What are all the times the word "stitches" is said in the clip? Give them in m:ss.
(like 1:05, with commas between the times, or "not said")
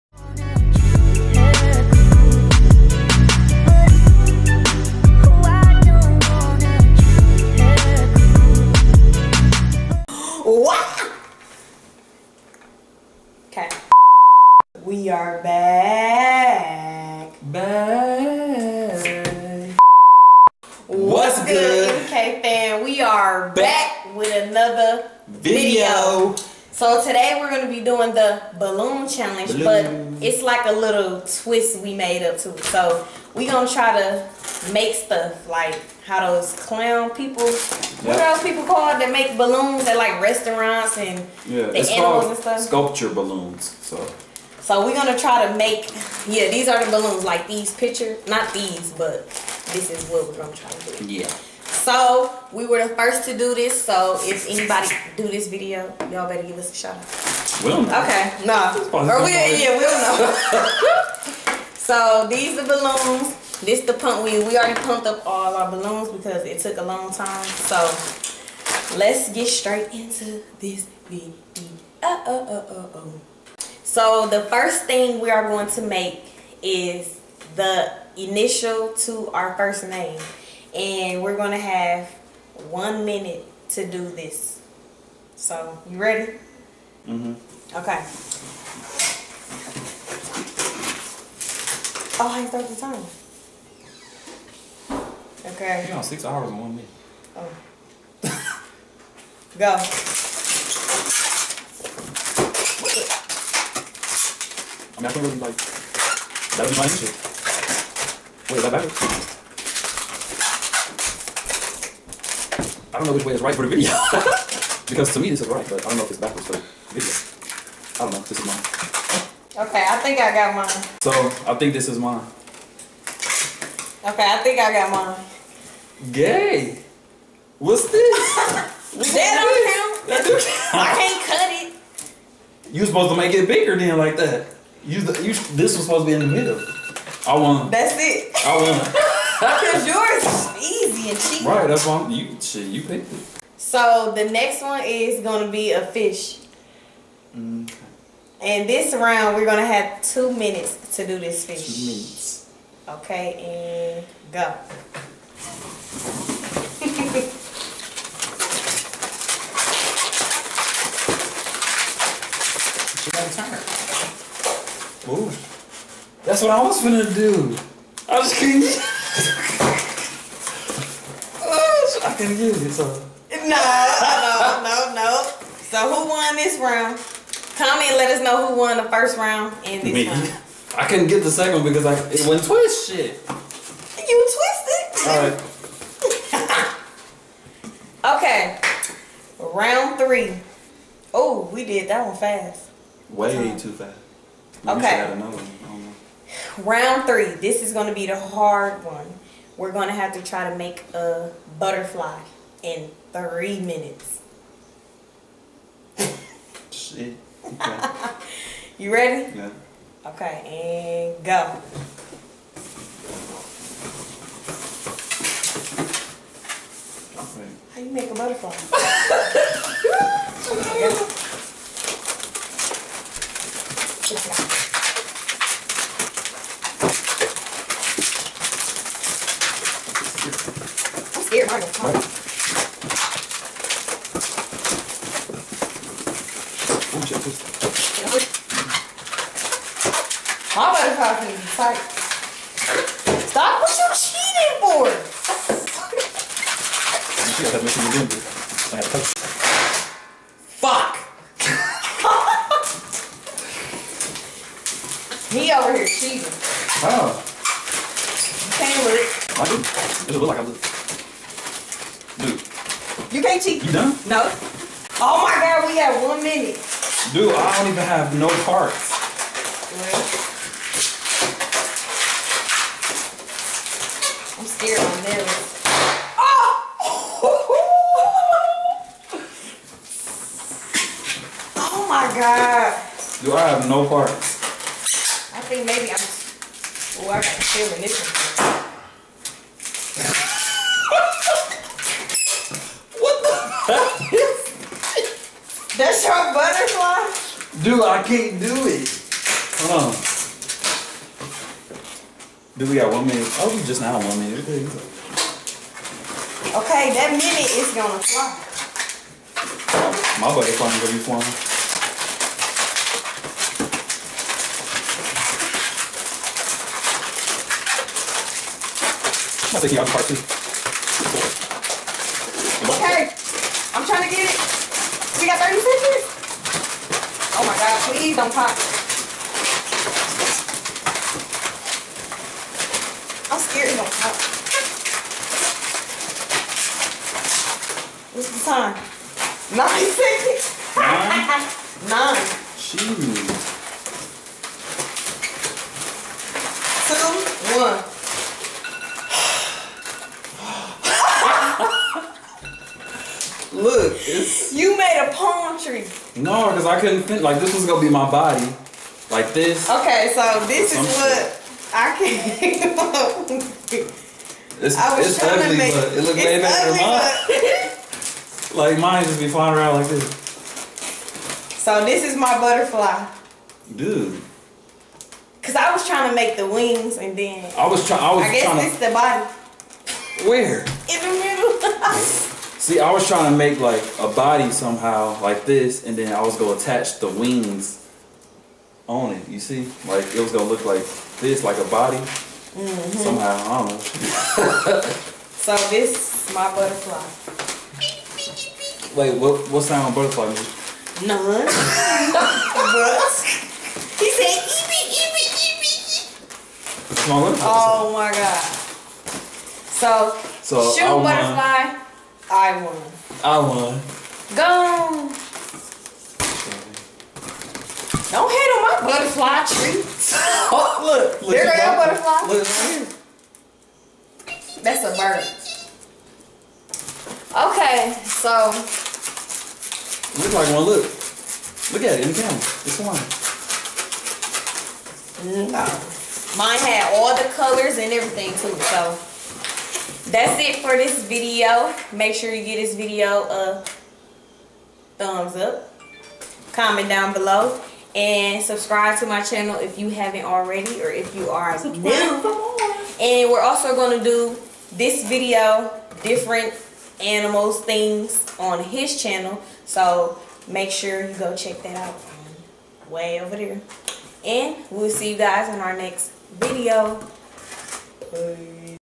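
5:25.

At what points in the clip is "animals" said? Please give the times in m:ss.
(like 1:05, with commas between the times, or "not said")
0:41, 7:37.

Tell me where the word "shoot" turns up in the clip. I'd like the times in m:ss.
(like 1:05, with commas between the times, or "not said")
6:50.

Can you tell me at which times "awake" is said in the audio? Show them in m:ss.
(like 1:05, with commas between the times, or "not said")
not said.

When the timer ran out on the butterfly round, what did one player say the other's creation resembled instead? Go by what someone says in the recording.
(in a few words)
palm tree.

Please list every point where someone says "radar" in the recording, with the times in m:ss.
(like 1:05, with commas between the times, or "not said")
not said.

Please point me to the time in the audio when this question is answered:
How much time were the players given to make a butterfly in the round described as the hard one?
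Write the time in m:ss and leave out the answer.
3:23.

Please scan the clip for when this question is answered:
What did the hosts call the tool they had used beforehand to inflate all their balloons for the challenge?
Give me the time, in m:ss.
1:03.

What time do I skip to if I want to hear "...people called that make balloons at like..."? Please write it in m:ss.
0:38.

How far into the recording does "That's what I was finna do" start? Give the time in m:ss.
2:46.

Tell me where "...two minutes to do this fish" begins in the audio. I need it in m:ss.
2:30.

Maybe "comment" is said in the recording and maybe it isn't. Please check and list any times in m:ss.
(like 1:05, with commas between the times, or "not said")
2:57, 7:26.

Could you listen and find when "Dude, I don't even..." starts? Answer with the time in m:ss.
4:27.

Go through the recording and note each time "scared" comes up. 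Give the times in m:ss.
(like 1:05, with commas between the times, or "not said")
4:34, 5:33.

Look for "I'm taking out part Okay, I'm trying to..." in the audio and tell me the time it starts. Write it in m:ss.
5:19.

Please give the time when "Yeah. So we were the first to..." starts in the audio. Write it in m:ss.
0:51.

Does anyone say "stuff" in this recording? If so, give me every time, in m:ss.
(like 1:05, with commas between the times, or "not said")
0:34, 0:42.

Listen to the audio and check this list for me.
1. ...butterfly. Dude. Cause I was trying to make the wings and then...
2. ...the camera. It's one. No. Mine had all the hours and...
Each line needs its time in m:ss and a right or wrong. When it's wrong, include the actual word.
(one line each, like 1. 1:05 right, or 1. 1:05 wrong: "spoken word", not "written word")
1. 6:12 right
2. 7:12 wrong: "colors", not "hours".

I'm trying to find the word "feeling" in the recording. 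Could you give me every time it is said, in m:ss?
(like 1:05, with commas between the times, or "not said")
4:47.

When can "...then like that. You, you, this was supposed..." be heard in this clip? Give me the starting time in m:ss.
2:13.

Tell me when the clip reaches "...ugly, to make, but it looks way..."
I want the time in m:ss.
6:05.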